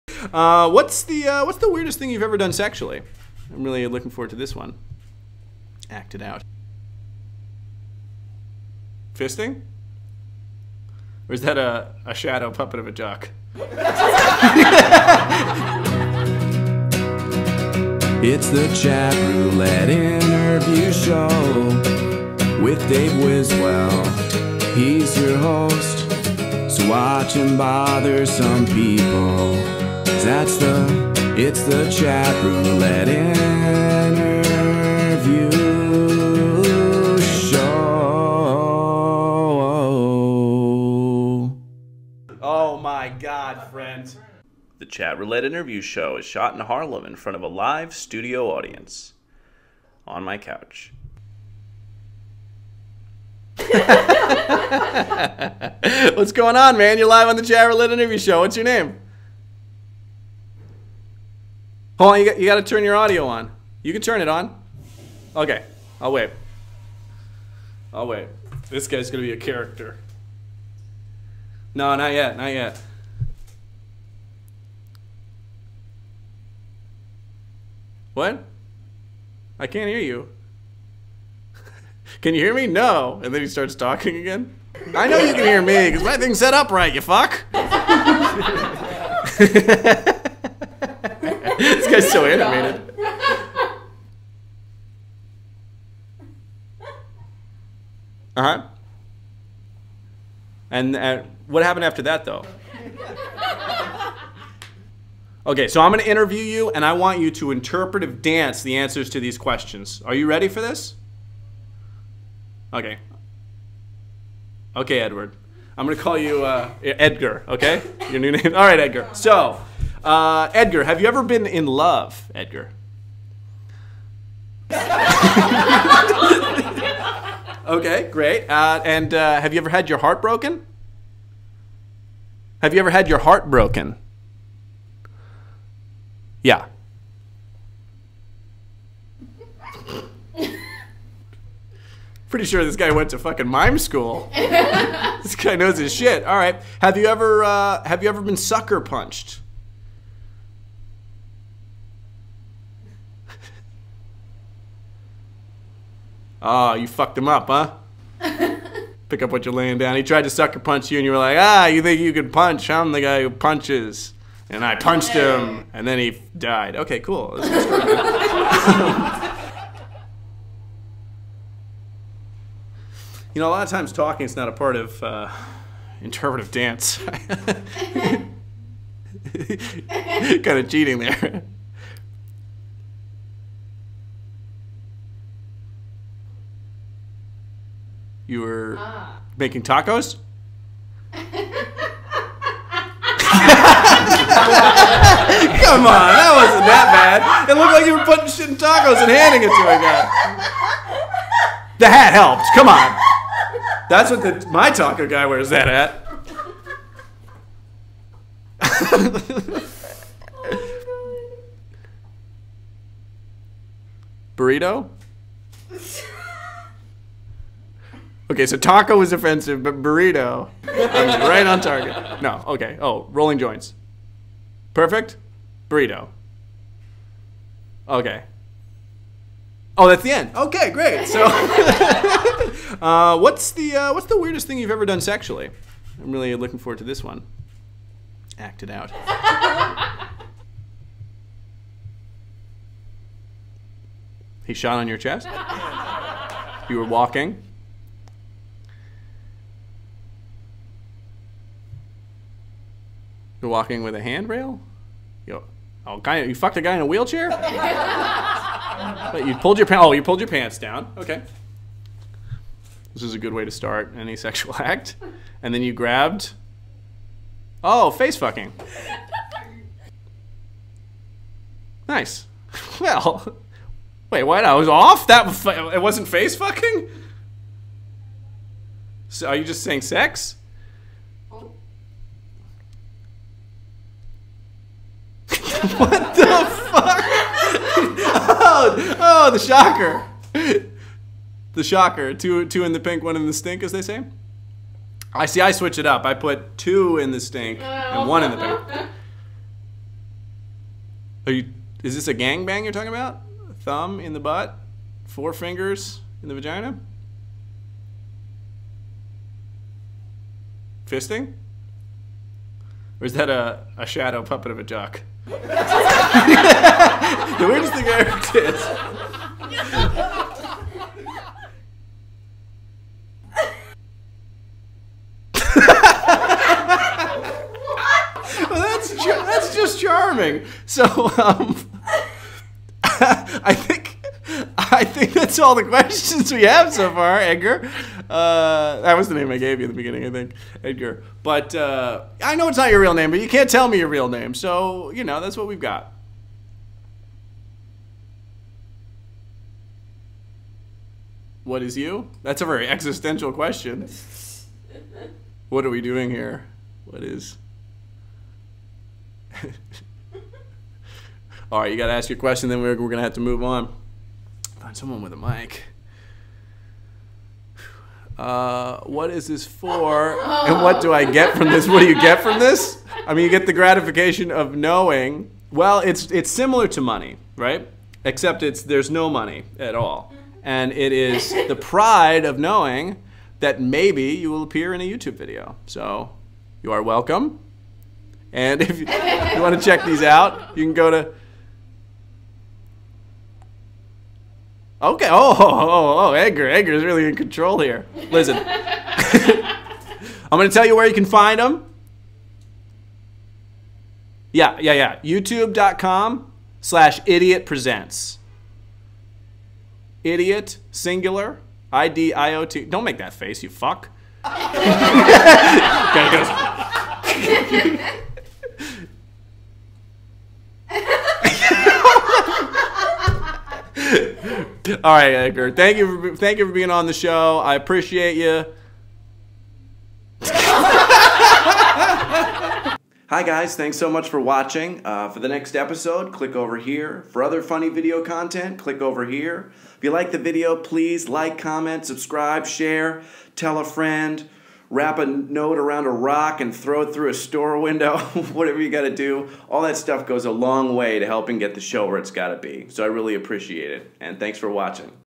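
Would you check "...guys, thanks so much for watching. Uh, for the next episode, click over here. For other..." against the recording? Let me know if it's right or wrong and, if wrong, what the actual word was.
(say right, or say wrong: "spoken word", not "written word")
right.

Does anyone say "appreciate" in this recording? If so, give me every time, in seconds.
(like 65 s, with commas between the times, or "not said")
427 s, 453 s.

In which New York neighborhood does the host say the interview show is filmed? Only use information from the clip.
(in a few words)
Harlem.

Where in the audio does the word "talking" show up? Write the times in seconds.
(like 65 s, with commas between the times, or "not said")
83 s, 173 s, 302 s.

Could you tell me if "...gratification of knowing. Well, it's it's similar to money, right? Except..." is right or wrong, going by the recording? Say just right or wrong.
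right.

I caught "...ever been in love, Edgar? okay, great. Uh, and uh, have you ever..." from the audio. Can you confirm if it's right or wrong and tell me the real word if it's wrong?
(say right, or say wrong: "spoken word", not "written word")
right.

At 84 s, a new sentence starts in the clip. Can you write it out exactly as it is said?
I know you can hear me, because my thing's set up right, you fuck.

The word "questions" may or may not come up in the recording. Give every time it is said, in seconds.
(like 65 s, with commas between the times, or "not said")
109 s, 335 s, 353 s, 362 s.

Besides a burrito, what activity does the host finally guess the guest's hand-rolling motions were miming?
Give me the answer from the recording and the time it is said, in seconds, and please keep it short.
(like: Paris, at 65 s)
Rolling joints, at 223 s.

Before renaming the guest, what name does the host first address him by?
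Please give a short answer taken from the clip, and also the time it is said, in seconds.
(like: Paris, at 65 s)
Edward, at 114 s.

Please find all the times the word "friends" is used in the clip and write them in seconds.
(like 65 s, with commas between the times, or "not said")
43 s, 443 s.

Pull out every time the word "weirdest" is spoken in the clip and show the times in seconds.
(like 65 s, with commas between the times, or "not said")
1 s, 234 s, 317 s.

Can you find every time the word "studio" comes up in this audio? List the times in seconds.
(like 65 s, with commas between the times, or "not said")
47 s.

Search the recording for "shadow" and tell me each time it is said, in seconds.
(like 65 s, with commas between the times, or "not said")
12 s, 313 s.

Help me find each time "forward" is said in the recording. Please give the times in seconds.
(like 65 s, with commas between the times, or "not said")
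4 s, 236 s.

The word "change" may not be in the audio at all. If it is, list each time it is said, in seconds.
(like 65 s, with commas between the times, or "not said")
not said.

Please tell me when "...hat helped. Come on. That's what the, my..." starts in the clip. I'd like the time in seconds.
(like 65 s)
201 s.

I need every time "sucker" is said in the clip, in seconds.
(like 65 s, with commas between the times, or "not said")
148 s, 160 s.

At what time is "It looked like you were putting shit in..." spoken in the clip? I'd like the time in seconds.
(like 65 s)
197 s.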